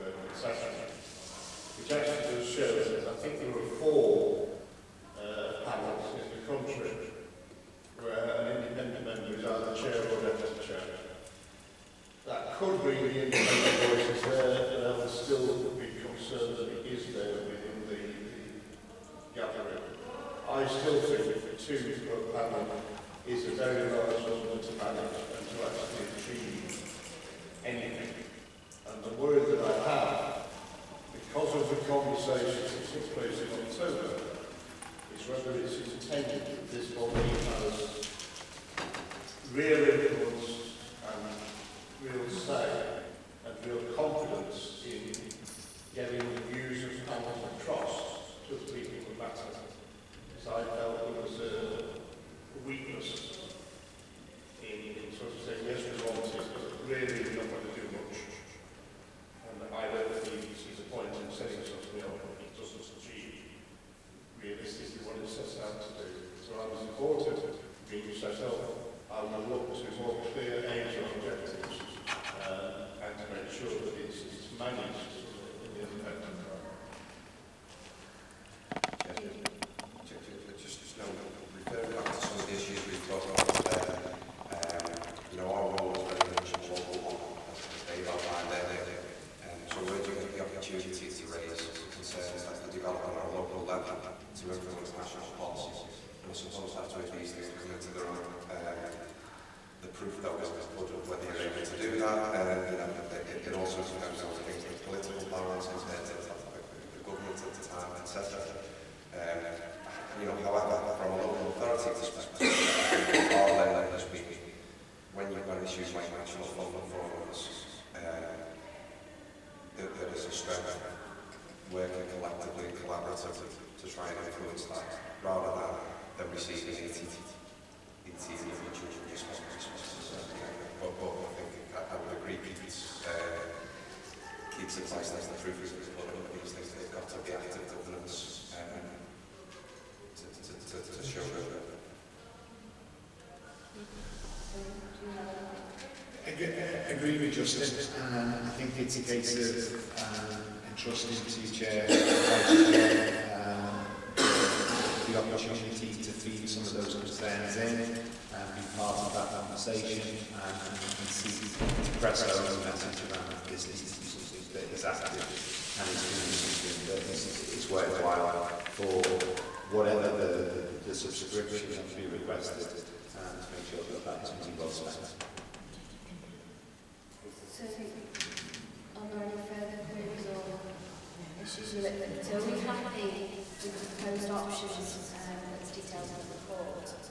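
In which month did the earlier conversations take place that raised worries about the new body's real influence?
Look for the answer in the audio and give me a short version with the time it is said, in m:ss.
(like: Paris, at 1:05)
October, at 0:33.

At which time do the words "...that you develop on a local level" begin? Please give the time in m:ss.
1:32.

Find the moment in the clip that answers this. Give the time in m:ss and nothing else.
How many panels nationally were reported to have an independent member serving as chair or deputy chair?
0:03.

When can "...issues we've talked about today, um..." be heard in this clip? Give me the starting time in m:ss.
1:22.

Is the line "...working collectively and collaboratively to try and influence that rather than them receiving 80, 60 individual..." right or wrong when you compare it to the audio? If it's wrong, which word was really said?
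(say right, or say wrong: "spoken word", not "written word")
wrong: "80", not "60".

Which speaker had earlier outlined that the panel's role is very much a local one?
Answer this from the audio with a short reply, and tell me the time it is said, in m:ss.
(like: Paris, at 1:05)
Dave, at 1:27.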